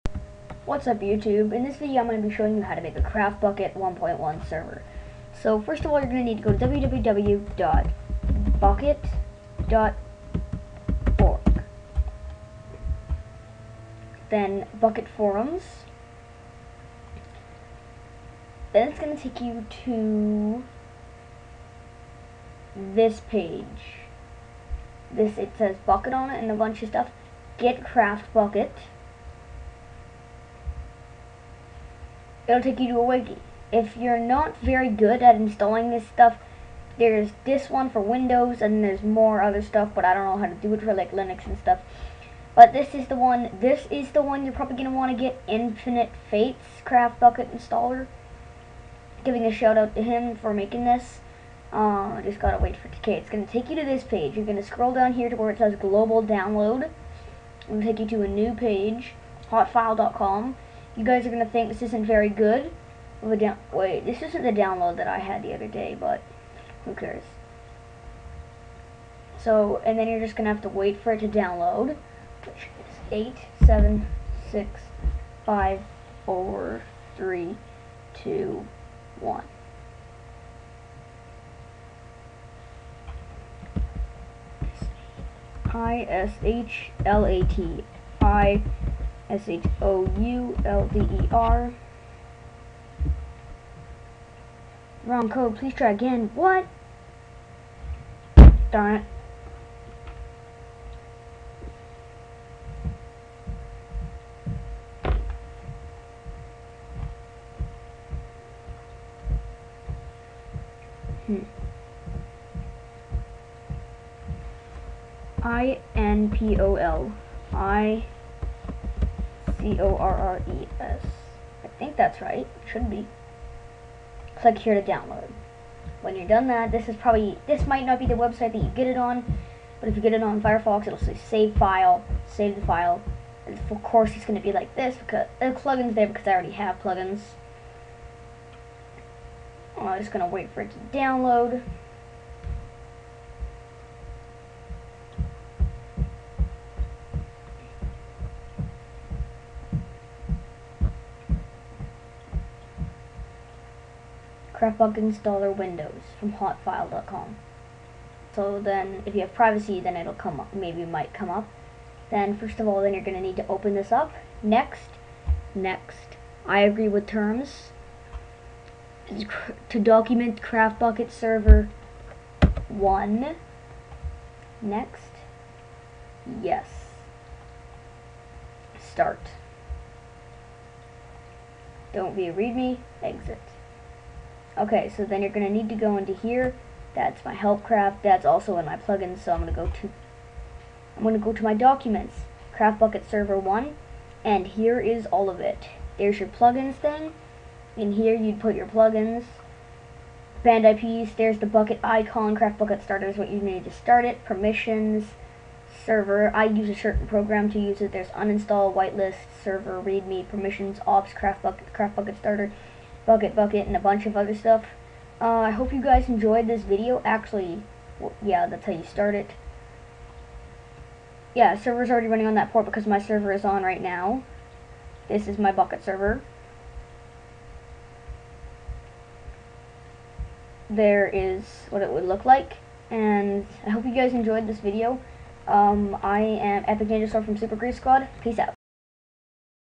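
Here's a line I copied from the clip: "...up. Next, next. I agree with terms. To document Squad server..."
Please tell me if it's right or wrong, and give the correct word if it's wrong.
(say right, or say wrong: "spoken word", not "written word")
wrong: "CraftBukkit", not "Squad".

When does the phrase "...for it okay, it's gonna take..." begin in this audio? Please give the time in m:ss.
0:52.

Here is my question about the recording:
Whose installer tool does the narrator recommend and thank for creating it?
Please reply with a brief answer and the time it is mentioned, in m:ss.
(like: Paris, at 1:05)
Infinite Fates, at 0:45.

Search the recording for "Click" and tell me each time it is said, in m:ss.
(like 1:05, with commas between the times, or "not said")
2:04.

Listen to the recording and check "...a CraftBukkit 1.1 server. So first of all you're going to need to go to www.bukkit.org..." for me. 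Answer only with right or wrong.
right.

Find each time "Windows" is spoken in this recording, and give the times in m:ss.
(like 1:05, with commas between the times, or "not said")
0:38, 2:35.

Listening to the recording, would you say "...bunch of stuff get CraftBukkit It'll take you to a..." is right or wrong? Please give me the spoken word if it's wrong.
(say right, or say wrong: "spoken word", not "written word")
right.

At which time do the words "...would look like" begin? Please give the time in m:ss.
3:51.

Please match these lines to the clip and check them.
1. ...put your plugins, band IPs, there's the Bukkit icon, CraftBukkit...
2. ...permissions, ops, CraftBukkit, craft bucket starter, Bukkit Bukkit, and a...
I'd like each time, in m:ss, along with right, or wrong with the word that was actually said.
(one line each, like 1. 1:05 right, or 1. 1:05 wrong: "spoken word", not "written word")
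1. 3:18 right
2. 3:30 right.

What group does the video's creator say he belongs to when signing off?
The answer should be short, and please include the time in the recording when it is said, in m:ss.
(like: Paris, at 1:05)
Super Grief Squad, at 3:57.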